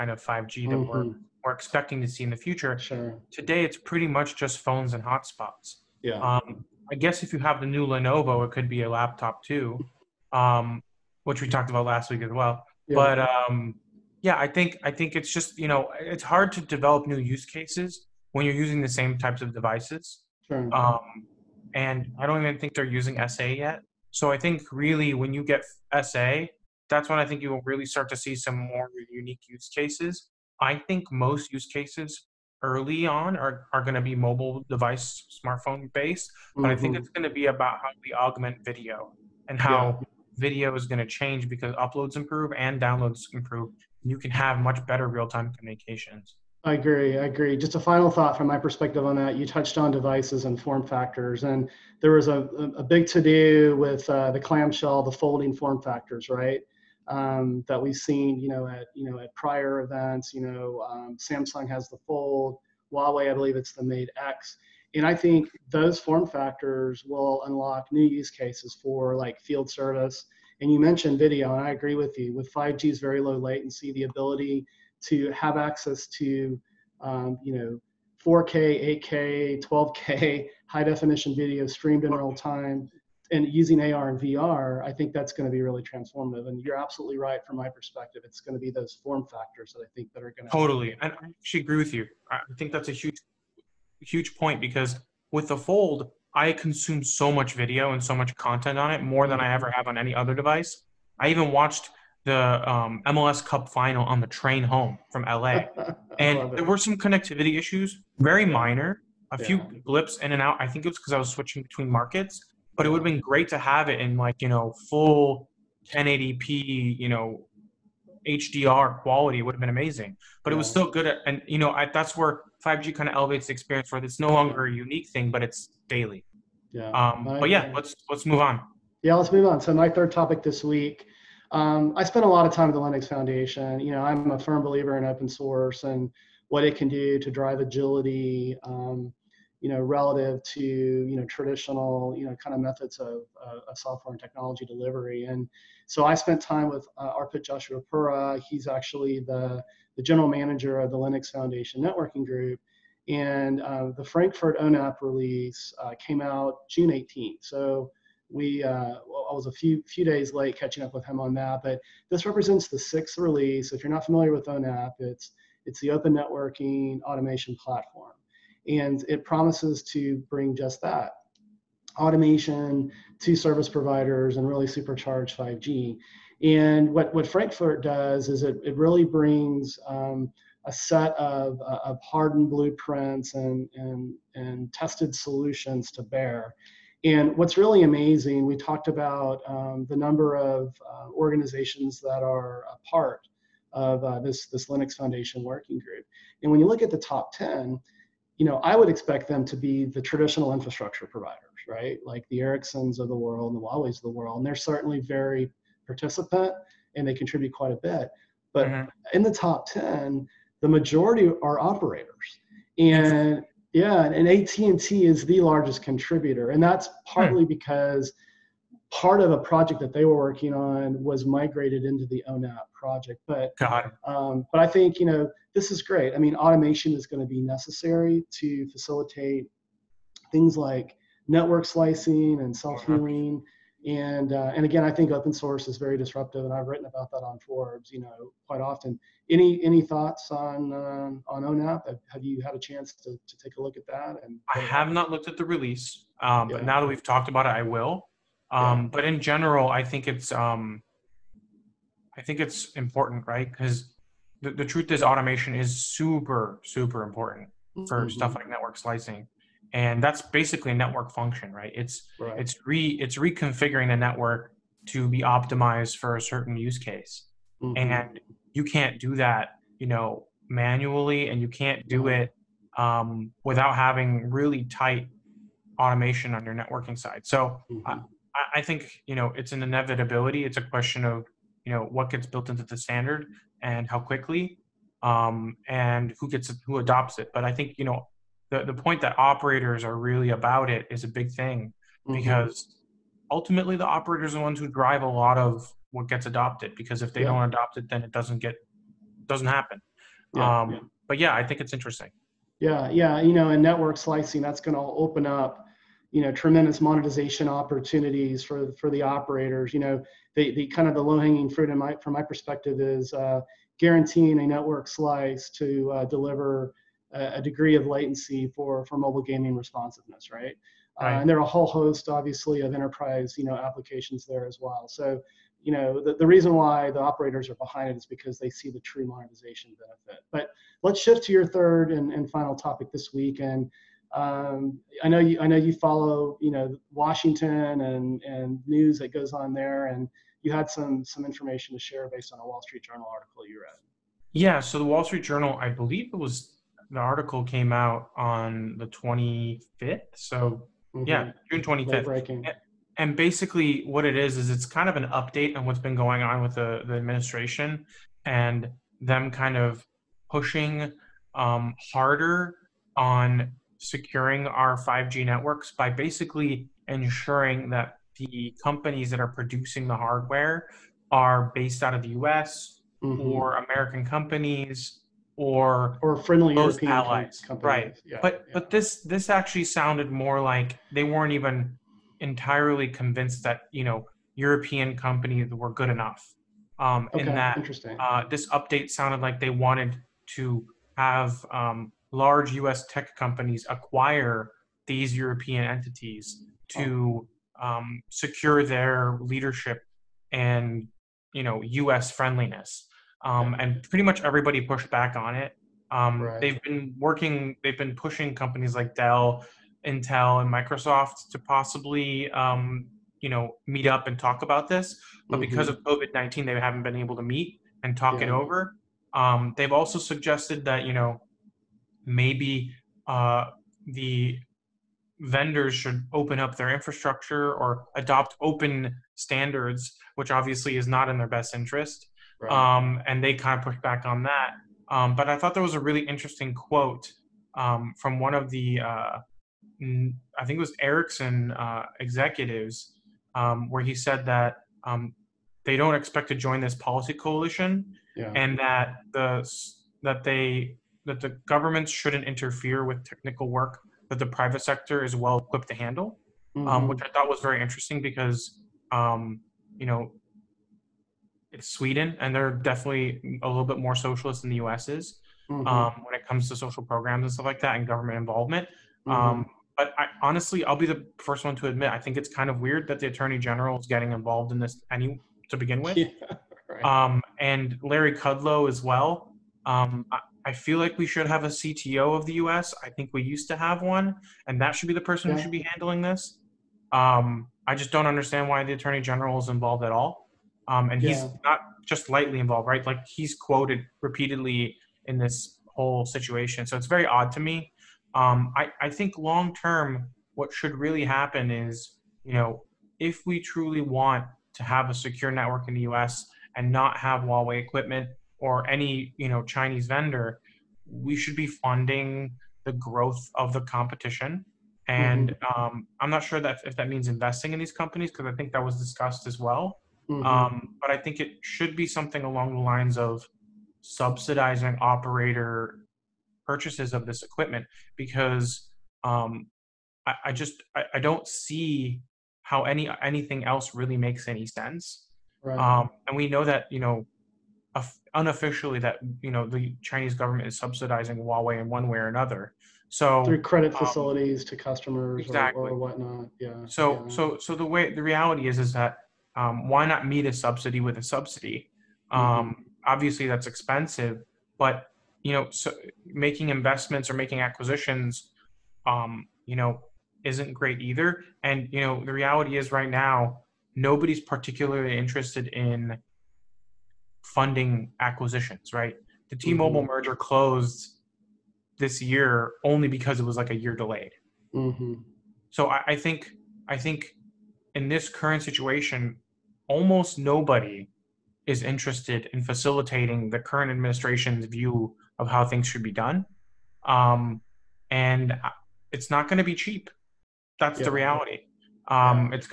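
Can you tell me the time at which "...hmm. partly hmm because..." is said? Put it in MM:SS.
03:36.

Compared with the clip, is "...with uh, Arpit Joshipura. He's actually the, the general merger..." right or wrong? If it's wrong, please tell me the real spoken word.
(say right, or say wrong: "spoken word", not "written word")
wrong: "manager", not "merger".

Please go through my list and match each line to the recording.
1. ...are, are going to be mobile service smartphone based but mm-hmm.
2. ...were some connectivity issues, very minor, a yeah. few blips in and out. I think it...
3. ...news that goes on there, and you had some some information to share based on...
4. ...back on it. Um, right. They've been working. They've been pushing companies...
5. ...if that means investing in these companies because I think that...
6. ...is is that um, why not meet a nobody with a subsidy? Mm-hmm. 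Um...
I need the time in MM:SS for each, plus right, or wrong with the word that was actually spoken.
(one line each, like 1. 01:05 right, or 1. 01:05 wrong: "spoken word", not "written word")
1. 00:33 wrong: "device", not "service"
2. 01:46 right
3. 05:38 right
4. 06:44 right
5. 08:36 right
6. 09:08 wrong: "subsidy", not "nobody".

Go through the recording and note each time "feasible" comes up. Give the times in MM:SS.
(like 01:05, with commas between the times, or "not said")
not said.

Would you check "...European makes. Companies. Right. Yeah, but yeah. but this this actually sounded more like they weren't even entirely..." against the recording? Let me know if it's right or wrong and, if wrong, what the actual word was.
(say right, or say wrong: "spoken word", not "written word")
wrong: "allies", not "makes".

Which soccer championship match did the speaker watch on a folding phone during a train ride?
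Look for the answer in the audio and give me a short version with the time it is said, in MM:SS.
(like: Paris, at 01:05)
MLS Cup final, at 01:43.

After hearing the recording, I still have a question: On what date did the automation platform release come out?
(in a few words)
June 18.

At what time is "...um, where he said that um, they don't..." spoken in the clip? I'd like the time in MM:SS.
07:23.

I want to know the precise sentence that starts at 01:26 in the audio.
And you're absolutely right from my perspective.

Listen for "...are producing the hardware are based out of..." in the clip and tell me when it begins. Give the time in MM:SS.
06:09.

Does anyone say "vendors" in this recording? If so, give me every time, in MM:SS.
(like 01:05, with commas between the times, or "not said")
07:05, 08:29.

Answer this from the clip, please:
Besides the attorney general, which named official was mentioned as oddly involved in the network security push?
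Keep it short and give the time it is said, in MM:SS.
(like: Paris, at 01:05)
Larry Kudlow, at 07:57.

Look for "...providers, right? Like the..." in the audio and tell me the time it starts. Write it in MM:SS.
03:21.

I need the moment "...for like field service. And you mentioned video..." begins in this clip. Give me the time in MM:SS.
01:08.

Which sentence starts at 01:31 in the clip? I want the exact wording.
And I actually agree with you.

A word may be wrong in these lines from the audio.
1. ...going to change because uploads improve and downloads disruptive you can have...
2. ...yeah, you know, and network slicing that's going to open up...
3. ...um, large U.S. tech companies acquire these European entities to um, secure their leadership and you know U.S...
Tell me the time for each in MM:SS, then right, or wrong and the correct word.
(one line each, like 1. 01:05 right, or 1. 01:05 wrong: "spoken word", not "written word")
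1. 00:40 wrong: "improve", not "disruptive"
2. 05:02 right
3. 06:31 right.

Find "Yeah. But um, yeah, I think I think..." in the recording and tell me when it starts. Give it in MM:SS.
00:12.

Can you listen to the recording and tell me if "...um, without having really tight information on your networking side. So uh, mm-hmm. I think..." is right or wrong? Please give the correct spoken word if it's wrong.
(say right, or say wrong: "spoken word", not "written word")
wrong: "automation", not "information".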